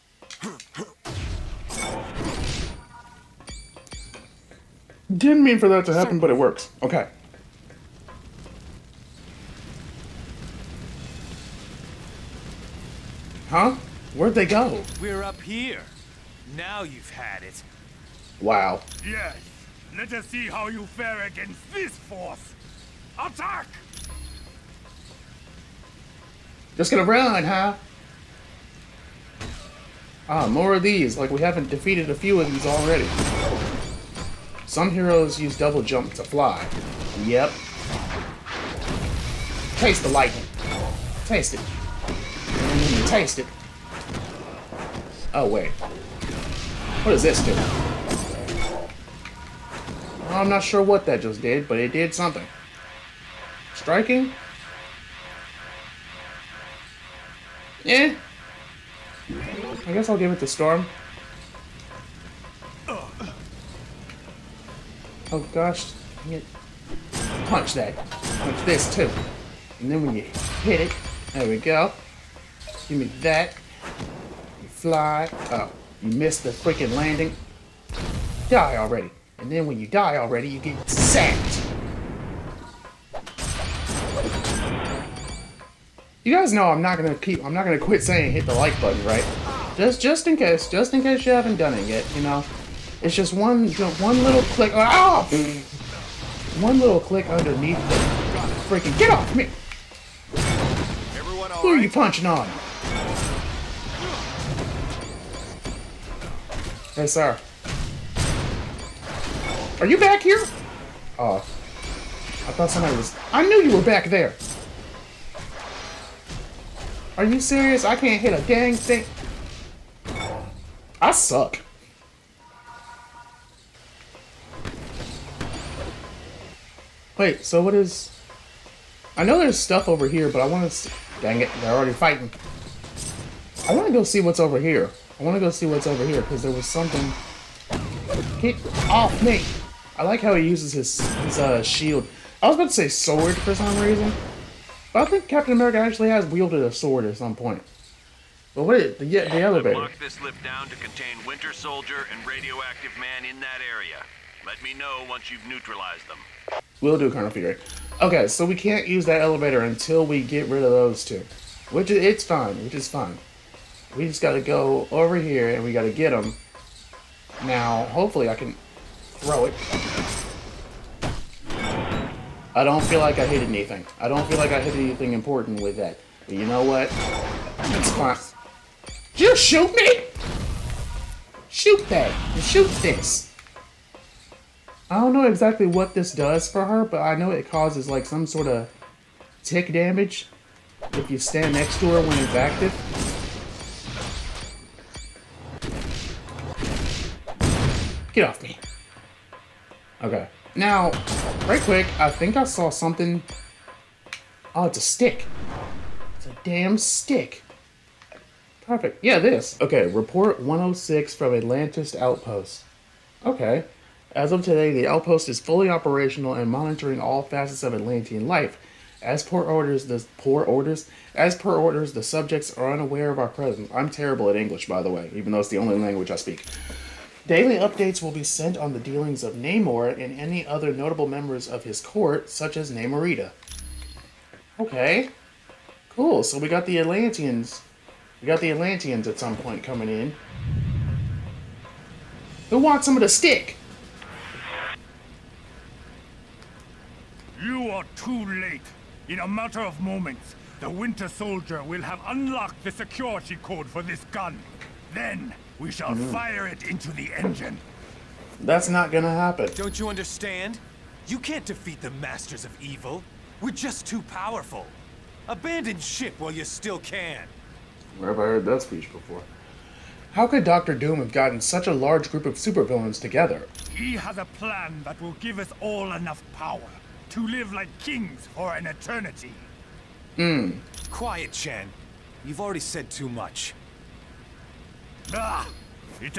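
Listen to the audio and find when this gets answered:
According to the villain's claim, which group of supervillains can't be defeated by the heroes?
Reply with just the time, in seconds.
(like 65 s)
261 s.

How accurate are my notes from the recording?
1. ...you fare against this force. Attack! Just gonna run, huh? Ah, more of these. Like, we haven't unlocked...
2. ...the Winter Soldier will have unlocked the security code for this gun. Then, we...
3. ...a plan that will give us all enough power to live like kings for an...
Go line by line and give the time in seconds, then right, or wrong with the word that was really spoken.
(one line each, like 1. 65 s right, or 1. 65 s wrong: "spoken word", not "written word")
1. 20 s wrong: "defeated", not "unlocked"
2. 250 s right
3. 274 s right.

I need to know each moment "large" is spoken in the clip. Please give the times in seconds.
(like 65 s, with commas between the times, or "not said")
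271 s.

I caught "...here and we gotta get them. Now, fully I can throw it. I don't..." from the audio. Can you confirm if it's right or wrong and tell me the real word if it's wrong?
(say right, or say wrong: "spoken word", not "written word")
wrong: "hopefully", not "fully".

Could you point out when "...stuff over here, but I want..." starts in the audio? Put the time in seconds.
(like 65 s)
129 s.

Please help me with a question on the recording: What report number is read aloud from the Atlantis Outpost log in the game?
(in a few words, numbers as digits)
106.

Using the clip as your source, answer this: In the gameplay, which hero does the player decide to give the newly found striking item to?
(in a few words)
Storm.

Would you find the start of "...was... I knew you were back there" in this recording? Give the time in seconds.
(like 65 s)
112 s.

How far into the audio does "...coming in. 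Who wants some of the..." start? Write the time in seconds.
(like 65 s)
239 s.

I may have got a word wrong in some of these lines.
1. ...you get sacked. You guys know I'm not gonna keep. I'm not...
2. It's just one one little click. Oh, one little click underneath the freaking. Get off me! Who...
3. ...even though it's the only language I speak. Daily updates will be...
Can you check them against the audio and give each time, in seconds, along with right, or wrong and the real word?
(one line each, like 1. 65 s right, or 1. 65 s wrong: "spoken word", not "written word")
1. 80 s right
2. 93 s right
3. 225 s right.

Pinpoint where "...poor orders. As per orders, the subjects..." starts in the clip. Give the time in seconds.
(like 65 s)
220 s.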